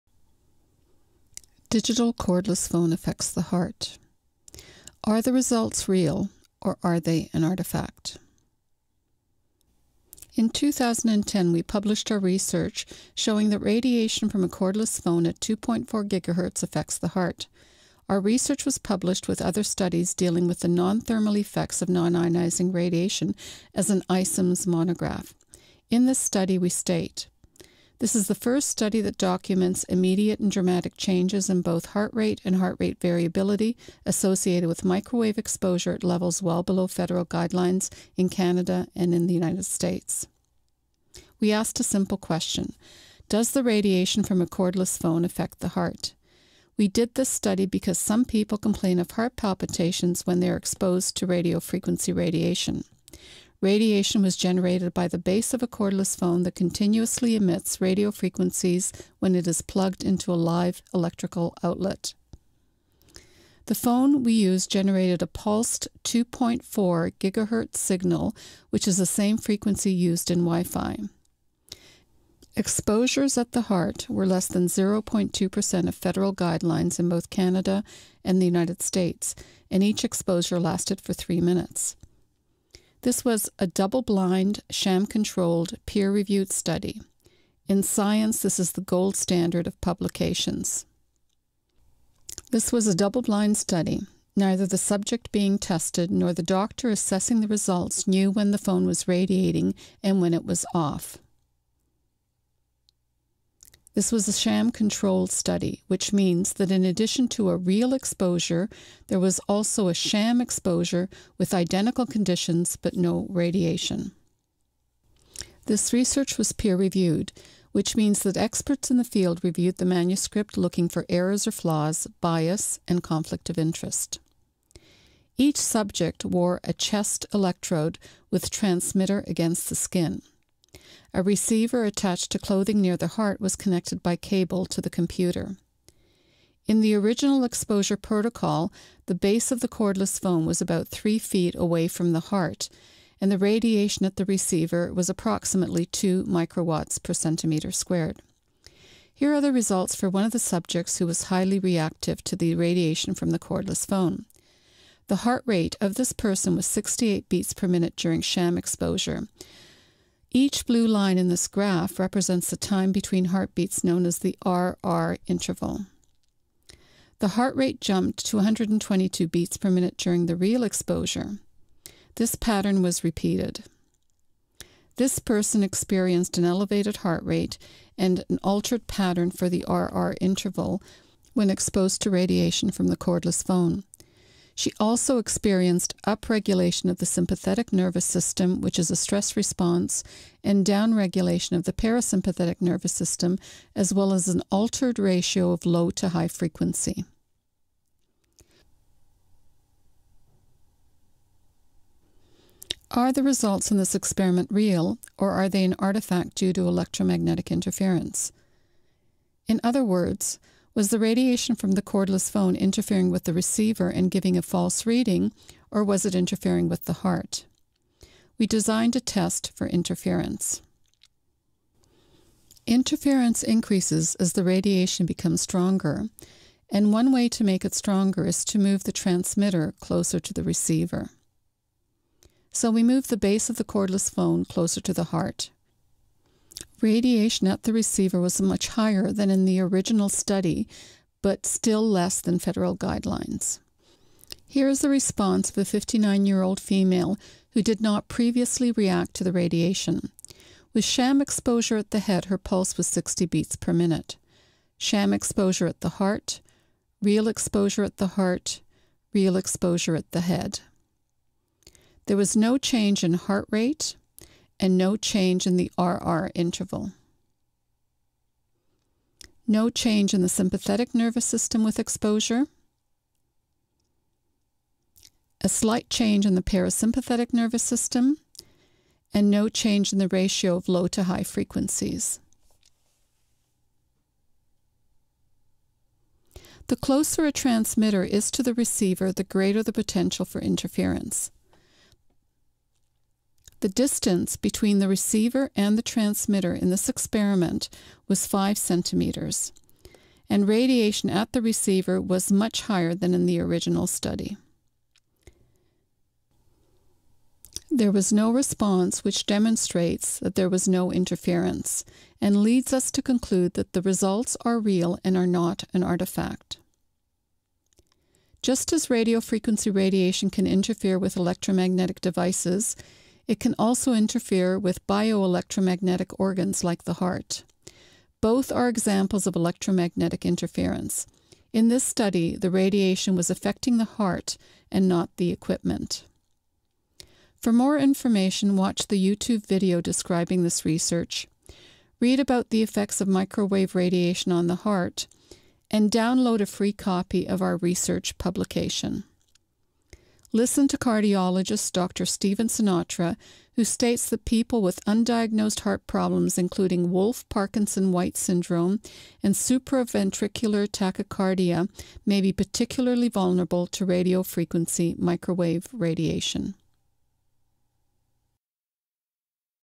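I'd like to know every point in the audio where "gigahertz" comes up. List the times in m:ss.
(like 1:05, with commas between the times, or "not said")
0:16, 1:07.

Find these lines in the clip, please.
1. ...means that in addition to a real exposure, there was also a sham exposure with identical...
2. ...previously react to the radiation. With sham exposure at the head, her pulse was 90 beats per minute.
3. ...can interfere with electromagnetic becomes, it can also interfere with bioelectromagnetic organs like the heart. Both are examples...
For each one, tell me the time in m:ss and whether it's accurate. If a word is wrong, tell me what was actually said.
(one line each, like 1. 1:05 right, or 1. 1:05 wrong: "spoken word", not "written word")
1. 1:46 right
2. 4:08 wrong: "60", not "90"
3. 5:20 wrong: "devices", not "becomes".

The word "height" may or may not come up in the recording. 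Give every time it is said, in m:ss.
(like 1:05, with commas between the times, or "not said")
not said.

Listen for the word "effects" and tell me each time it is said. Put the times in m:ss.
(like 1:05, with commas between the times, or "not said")
0:21, 5:42.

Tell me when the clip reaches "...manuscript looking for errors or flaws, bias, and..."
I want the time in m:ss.
1:59.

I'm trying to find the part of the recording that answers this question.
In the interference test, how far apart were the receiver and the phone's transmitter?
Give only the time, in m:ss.
4:58.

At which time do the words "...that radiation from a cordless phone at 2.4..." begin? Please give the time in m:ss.
0:13.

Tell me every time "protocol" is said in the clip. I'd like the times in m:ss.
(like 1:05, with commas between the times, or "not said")
2:17.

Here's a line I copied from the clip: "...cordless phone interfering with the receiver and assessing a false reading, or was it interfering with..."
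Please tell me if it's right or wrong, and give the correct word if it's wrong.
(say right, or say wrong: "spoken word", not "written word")
wrong: "giving", not "assessing".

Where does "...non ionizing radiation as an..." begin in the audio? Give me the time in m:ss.
0:21.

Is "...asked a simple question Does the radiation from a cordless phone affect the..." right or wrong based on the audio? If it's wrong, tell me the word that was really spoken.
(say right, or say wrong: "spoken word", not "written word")
right.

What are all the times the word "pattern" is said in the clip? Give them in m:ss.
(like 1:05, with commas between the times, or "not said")
2:52, 2:58.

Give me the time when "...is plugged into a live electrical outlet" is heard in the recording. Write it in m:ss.
0:59.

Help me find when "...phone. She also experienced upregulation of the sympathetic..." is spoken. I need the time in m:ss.
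3:03.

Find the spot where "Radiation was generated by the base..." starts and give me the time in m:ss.
0:53.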